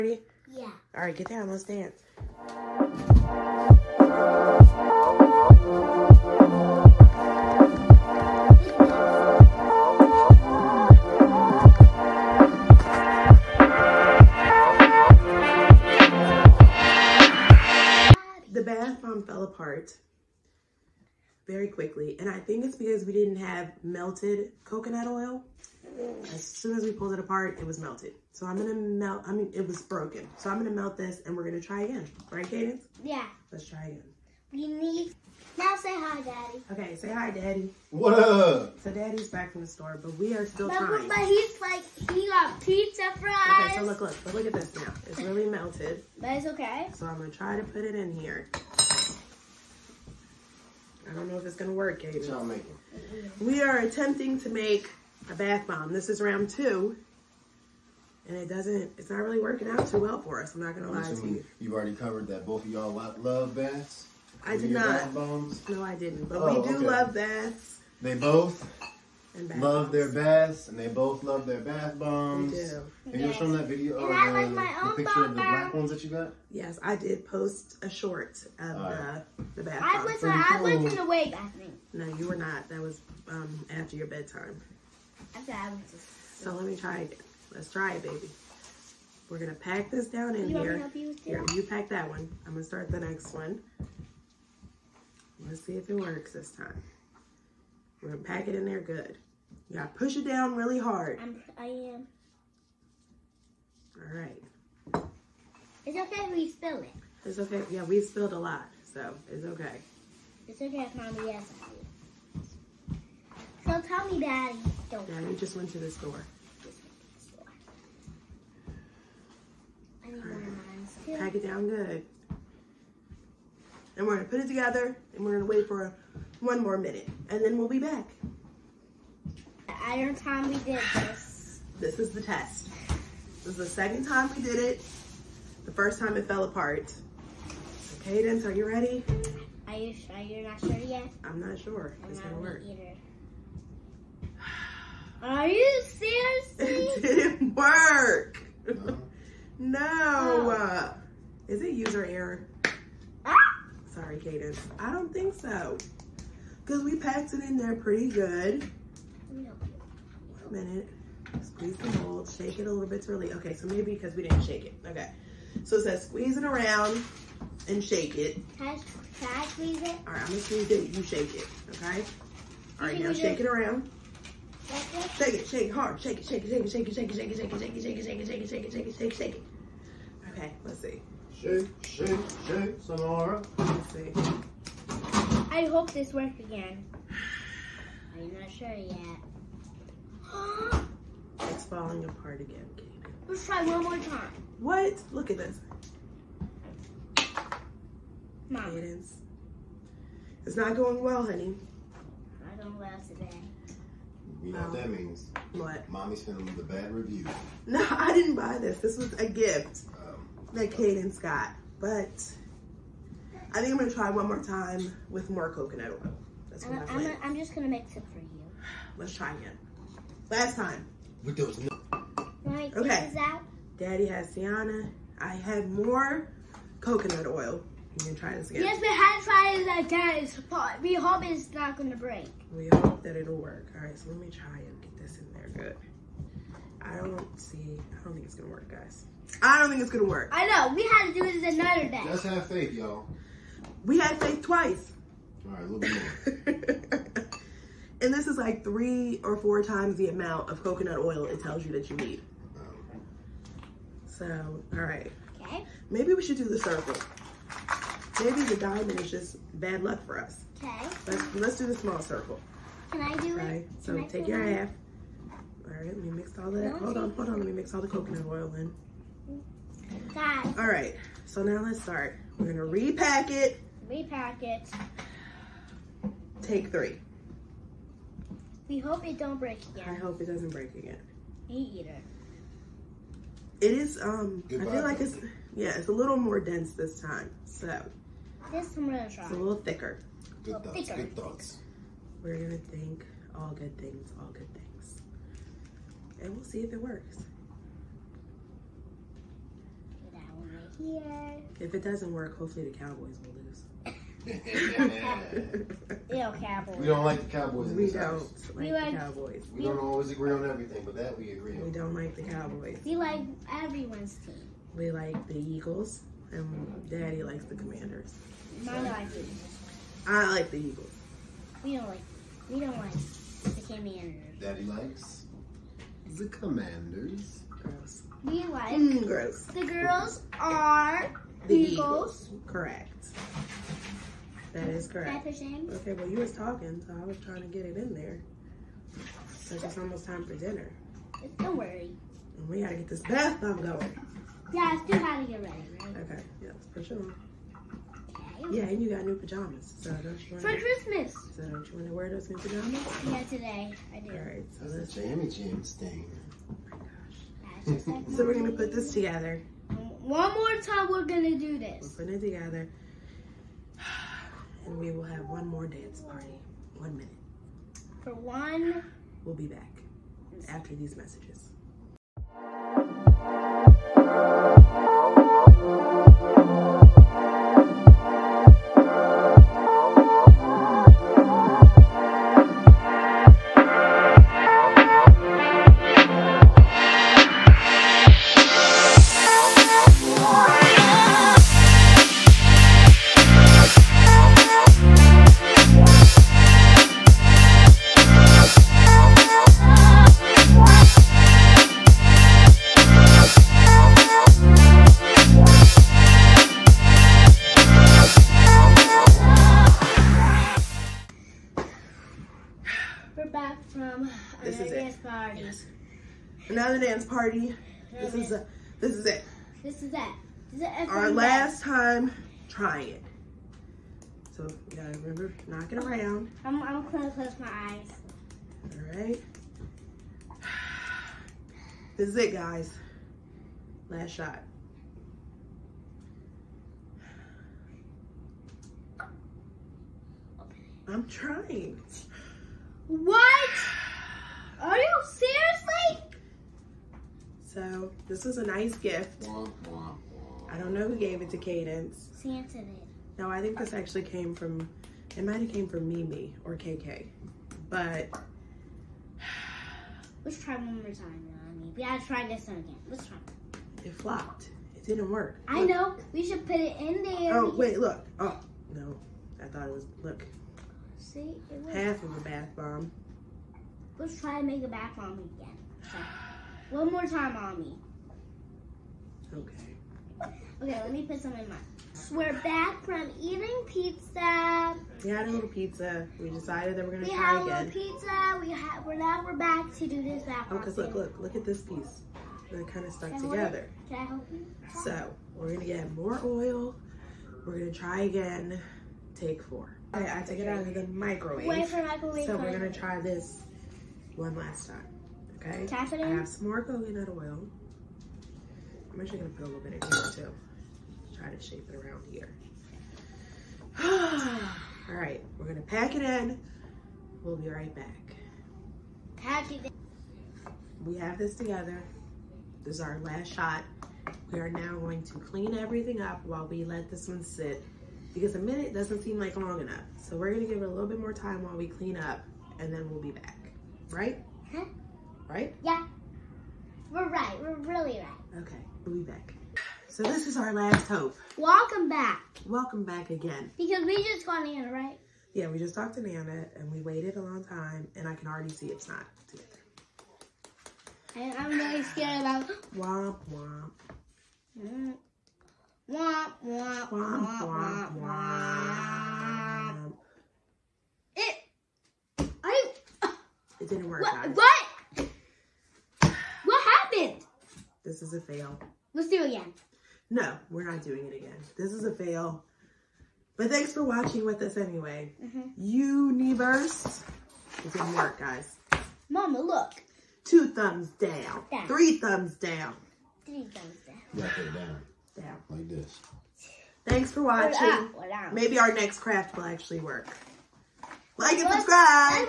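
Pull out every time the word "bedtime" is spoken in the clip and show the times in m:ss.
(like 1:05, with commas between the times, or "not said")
1:24.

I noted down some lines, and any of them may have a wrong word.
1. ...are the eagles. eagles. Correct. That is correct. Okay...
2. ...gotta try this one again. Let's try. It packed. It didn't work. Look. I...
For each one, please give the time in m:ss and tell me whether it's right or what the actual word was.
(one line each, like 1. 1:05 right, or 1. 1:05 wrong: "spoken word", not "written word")
1. 5:30 right
2. 7:41 wrong: "flopped", not "packed".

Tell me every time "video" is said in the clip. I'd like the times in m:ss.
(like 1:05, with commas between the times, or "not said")
1:13.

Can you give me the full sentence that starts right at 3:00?
Okay, let's see shake, shake, shake some I hope this works again.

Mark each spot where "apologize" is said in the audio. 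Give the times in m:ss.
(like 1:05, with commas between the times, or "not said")
not said.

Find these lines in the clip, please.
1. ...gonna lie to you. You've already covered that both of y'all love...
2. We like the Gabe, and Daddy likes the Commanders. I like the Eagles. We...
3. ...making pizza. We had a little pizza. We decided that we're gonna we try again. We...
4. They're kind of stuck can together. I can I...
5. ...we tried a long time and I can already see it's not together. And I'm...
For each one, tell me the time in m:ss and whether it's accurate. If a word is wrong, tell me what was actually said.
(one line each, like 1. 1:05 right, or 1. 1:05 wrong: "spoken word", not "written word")
1. 1:00 right
2. 5:14 wrong: "Eagles", not "Gabe"
3. 8:03 wrong: "eating", not "making"
4. 8:12 right
5. 9:06 wrong: "waited", not "tried".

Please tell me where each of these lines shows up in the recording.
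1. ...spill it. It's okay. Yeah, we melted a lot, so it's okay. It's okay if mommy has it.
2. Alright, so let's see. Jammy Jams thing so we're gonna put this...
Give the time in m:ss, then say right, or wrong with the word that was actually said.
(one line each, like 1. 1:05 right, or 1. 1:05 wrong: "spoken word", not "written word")
1. 1:46 wrong: "spilled", not "melted"
2. 5:54 right.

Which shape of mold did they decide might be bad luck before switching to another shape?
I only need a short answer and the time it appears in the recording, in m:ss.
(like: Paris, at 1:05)
diamond, at 4:18.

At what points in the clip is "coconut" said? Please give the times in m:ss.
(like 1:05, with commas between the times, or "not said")
0:24, 3:35, 3:46, 4:10, 4:27, 8:26.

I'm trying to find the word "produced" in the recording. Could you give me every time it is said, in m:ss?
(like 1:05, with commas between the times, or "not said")
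not said.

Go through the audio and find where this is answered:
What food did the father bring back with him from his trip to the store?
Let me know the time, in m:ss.
0:42.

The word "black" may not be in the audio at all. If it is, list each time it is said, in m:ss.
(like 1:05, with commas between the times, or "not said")
1:15.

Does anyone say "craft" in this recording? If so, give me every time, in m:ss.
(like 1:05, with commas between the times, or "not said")
9:48.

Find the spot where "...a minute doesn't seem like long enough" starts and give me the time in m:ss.
8:48.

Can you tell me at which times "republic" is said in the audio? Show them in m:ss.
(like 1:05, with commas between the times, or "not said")
not said.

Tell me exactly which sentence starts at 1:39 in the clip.
You gotta push it down really hard.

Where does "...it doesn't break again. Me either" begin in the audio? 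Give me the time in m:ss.
4:40.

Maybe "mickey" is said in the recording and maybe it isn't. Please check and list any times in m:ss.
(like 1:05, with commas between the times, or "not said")
not said.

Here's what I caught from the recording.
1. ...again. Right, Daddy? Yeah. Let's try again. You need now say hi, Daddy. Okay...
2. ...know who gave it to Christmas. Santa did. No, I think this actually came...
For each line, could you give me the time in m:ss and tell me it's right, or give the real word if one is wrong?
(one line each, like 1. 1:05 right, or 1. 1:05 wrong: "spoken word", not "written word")
1. 0:31 wrong: "Cadence", not "Daddy"
2. 7:30 wrong: "Cadence", not "Christmas".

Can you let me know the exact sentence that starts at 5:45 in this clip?
Okay, yeah, let's push it on.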